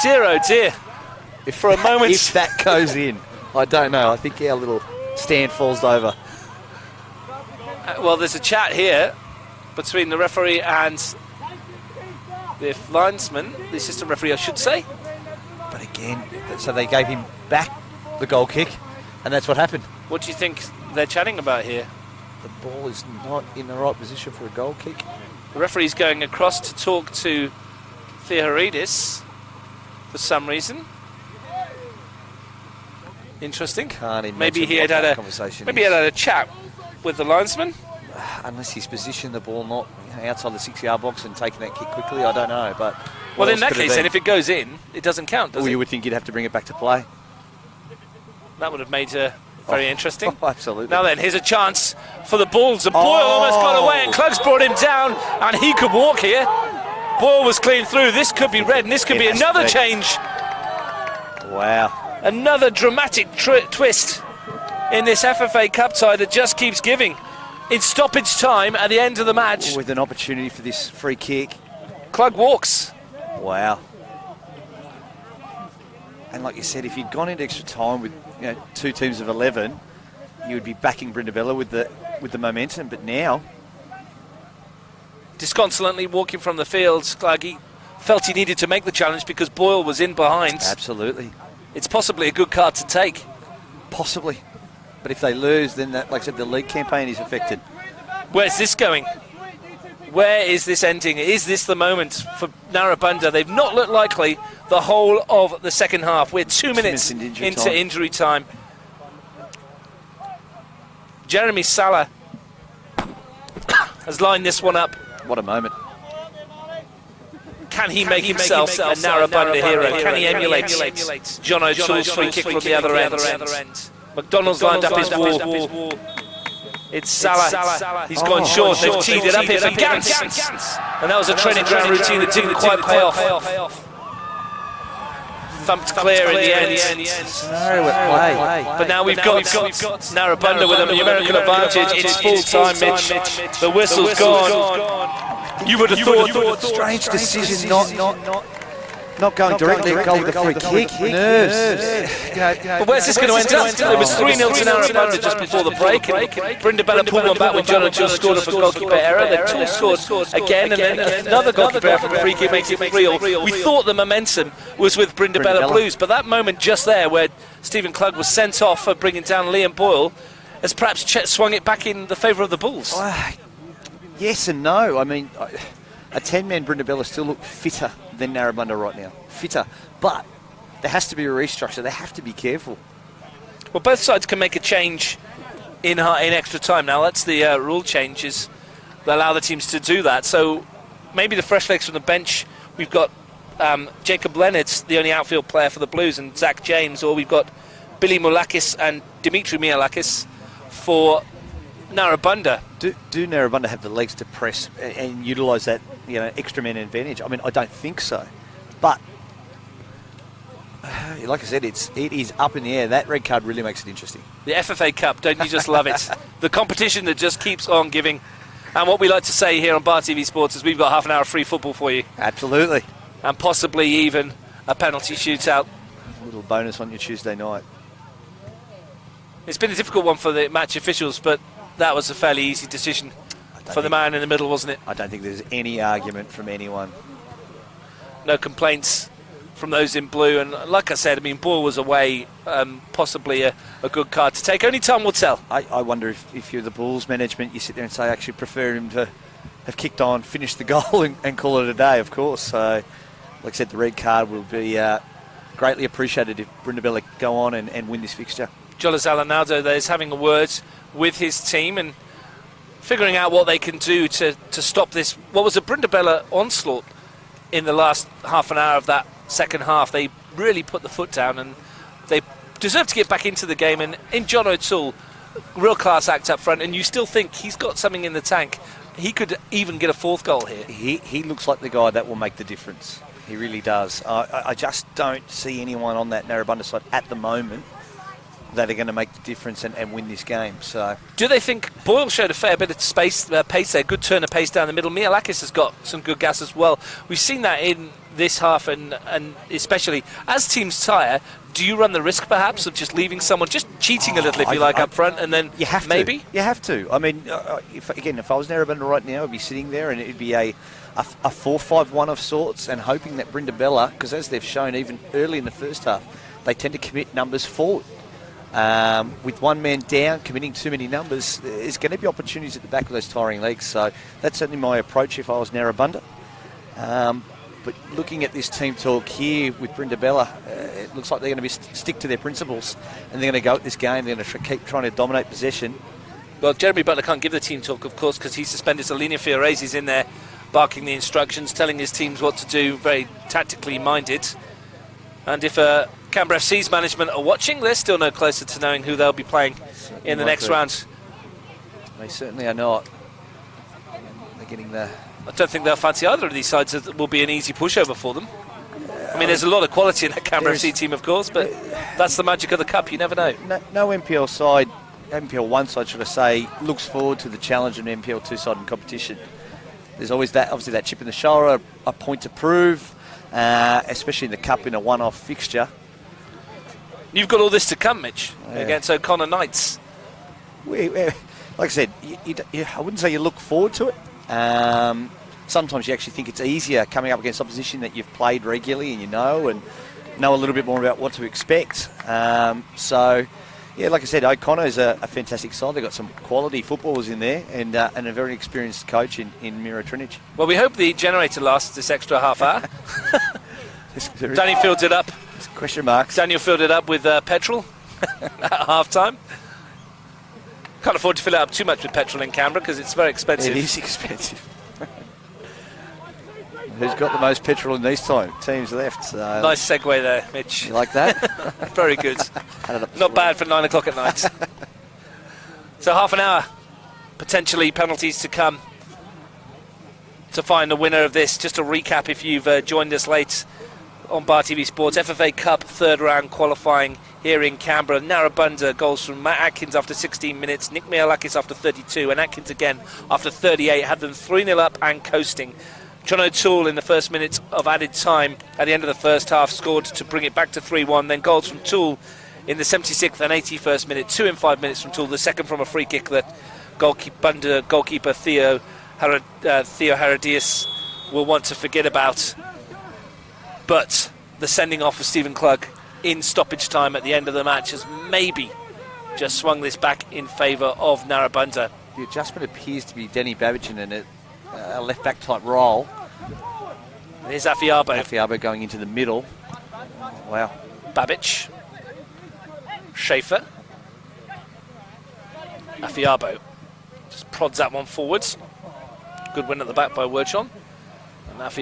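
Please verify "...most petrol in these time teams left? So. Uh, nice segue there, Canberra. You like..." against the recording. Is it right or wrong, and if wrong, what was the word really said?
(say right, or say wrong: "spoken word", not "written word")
wrong: "Mitch", not "Canberra".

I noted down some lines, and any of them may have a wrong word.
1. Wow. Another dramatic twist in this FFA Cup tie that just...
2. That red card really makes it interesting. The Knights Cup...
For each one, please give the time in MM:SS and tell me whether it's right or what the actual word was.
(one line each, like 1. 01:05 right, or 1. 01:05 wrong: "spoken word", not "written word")
1. 01:01 right
2. 03:32 wrong: "FFA", not "Knights".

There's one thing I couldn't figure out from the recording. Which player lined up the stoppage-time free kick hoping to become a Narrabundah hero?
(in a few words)
Jeremy Salah.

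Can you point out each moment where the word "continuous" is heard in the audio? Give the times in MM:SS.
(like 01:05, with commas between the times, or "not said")
not said.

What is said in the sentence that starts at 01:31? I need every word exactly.
It's possibly a good card to take.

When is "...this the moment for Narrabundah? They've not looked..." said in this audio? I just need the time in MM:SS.
01:41.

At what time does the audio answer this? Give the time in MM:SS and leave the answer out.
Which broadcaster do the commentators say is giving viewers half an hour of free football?
03:39.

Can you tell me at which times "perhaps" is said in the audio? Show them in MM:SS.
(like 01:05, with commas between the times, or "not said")
02:50, 05:02.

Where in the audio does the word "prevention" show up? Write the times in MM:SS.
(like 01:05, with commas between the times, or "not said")
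not said.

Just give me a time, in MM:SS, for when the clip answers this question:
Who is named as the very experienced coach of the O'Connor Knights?
06:39.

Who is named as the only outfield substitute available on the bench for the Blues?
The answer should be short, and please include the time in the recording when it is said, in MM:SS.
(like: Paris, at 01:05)
Jacob Leonard, at 03:14.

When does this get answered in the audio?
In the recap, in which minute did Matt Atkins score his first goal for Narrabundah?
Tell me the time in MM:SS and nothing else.
07:19.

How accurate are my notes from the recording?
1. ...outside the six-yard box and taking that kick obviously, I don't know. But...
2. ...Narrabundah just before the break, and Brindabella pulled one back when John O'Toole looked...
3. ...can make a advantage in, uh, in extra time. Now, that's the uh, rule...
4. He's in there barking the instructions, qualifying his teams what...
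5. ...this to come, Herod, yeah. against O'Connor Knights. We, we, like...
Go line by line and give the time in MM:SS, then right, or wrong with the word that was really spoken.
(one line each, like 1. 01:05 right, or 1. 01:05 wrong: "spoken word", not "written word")
1. 00:40 wrong: "quickly", not "obviously"
2. 02:34 wrong: "scored", not "looked"
3. 03:04 wrong: "change", not "advantage"
4. 05:39 wrong: "telling", not "qualifying"
5. 06:17 wrong: "Mitch", not "Herod".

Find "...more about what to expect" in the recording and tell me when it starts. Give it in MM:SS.
06:30.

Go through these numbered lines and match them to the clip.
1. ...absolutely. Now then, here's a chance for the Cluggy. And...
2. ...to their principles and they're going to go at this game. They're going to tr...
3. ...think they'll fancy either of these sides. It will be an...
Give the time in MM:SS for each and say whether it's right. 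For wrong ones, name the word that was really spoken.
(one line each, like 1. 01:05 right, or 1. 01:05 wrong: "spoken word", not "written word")
1. 00:50 wrong: "Bulls", not "Cluggy"
2. 05:31 right
3. 05:55 right.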